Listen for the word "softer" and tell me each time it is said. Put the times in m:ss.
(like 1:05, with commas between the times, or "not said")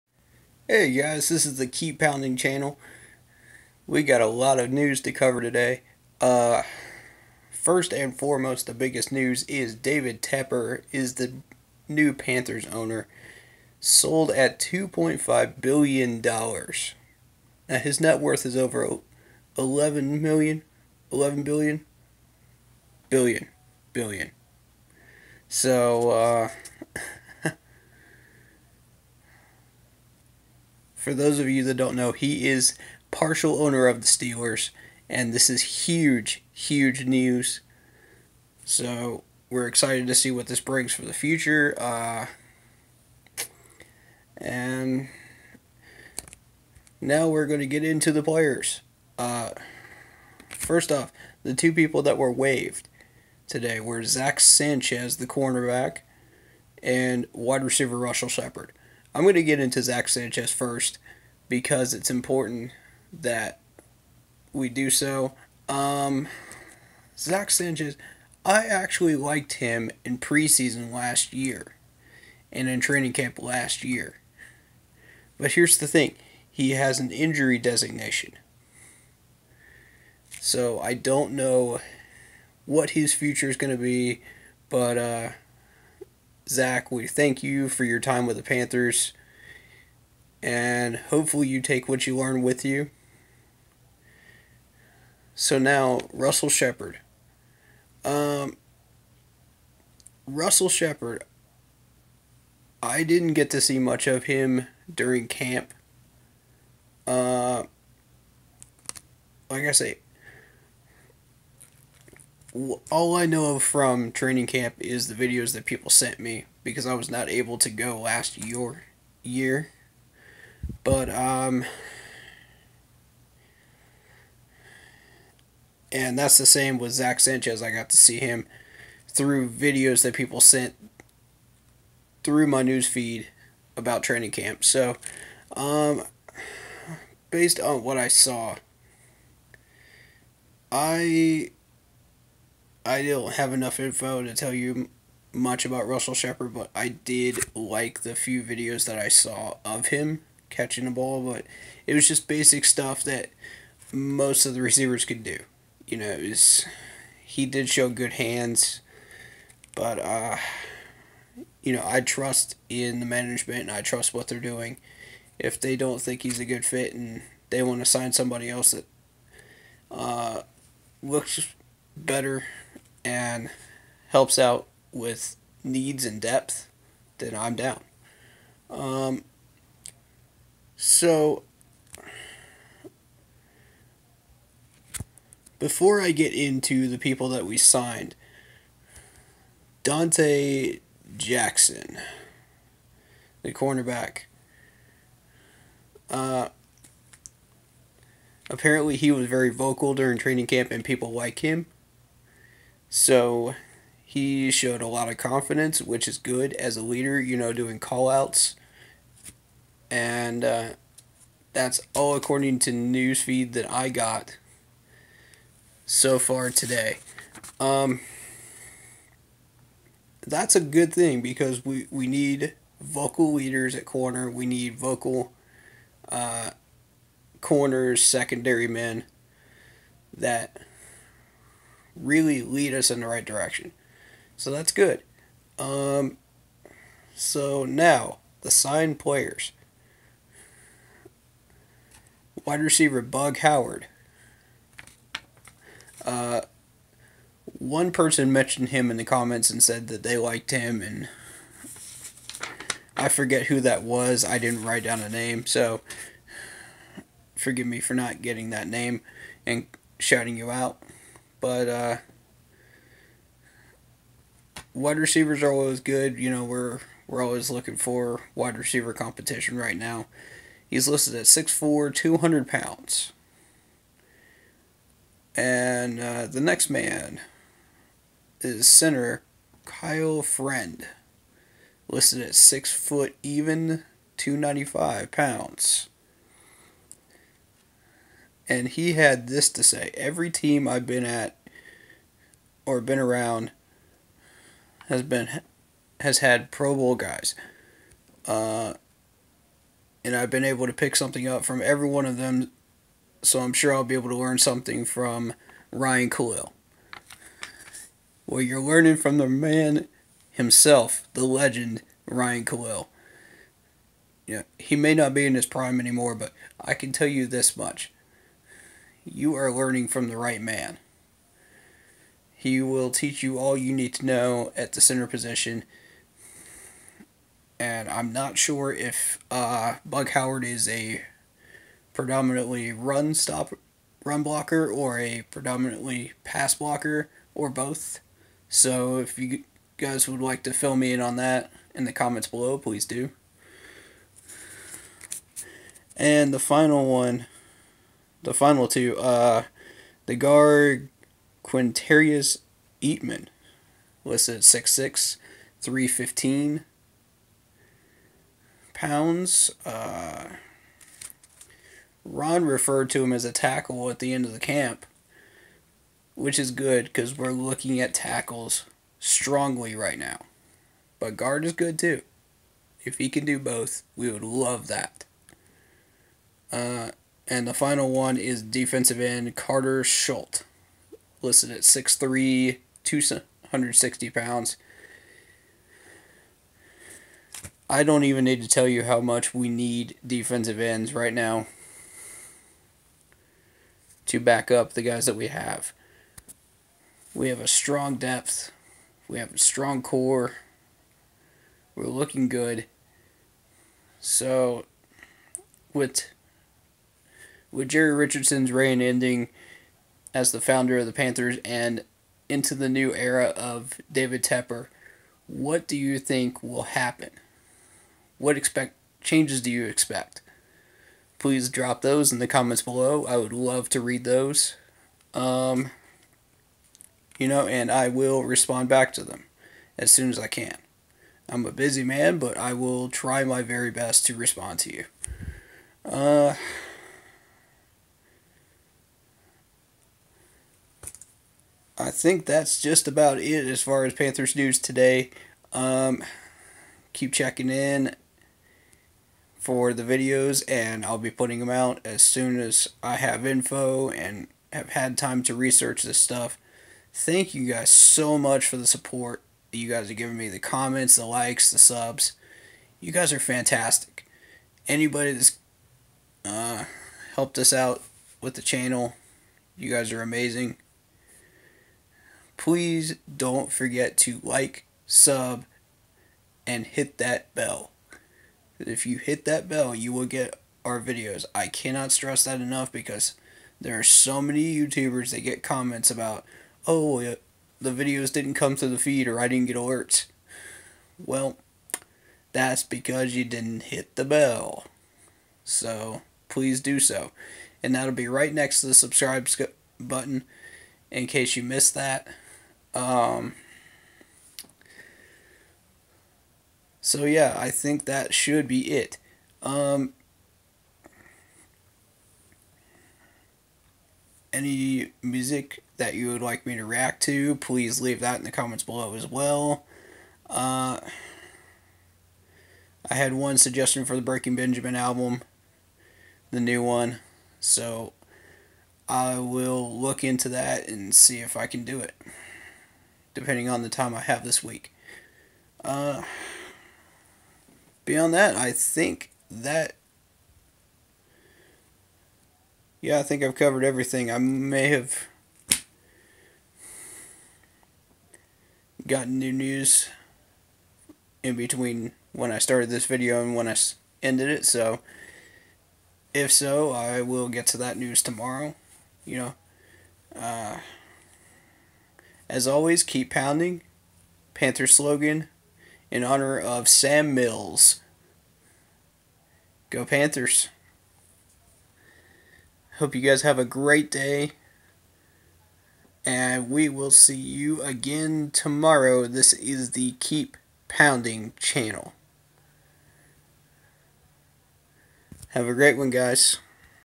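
not said.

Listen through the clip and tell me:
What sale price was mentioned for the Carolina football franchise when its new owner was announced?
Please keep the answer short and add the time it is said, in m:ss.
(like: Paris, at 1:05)
$2.5 billion, at 0:14.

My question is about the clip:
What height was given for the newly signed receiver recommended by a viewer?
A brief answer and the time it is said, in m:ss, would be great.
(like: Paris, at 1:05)
6'4", at 4:31.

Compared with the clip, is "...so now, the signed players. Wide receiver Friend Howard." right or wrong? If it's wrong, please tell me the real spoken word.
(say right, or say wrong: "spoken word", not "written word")
wrong: "Bug", not "Friend".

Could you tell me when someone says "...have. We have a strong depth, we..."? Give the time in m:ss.
6:35.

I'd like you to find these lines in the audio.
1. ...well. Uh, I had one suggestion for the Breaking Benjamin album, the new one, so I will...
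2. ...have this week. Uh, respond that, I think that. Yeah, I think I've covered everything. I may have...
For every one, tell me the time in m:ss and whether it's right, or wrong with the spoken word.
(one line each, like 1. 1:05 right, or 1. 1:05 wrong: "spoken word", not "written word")
1. 8:39 right
2. 8:54 wrong: "beyond", not "respond".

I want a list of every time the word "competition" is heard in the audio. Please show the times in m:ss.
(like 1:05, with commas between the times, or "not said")
4:28.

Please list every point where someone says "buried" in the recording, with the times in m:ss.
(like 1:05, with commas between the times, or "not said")
not said.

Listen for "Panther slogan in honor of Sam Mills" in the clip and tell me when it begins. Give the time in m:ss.
9:24.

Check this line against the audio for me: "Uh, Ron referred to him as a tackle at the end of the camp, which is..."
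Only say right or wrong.
right.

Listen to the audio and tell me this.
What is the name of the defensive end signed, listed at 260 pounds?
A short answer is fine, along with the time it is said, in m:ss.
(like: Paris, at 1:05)
Karter Shult, at 6:19.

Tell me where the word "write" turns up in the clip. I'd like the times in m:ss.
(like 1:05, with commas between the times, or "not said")
4:14.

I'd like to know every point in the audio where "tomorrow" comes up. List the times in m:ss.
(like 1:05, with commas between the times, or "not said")
9:18, 9:38.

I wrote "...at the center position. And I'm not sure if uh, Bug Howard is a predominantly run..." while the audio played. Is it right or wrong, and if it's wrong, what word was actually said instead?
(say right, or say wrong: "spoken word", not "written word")
right.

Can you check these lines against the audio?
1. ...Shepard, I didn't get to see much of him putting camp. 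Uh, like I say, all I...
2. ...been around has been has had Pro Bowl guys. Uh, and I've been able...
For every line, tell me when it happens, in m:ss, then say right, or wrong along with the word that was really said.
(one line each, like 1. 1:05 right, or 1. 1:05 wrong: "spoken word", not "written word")
1. 1:40 wrong: "during", not "putting"
2. 4:52 right.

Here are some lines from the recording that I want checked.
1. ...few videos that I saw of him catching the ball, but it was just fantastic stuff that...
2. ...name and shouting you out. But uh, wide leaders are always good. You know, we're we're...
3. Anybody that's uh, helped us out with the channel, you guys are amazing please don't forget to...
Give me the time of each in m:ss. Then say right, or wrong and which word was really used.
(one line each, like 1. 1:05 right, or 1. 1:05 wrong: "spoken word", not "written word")
1. 2:28 wrong: "basic", not "fantastic"
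2. 4:18 wrong: "receivers", not "leaders"
3. 7:44 right.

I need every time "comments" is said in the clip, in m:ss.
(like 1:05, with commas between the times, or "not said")
4:09, 5:41, 7:02, 7:40, 8:05, 8:38.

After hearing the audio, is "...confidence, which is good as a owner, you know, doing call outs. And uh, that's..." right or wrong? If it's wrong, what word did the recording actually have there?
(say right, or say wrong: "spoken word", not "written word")
wrong: "leader", not "owner".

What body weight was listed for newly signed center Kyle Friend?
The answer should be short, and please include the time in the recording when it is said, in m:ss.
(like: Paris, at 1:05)
295 pounds, at 4:44.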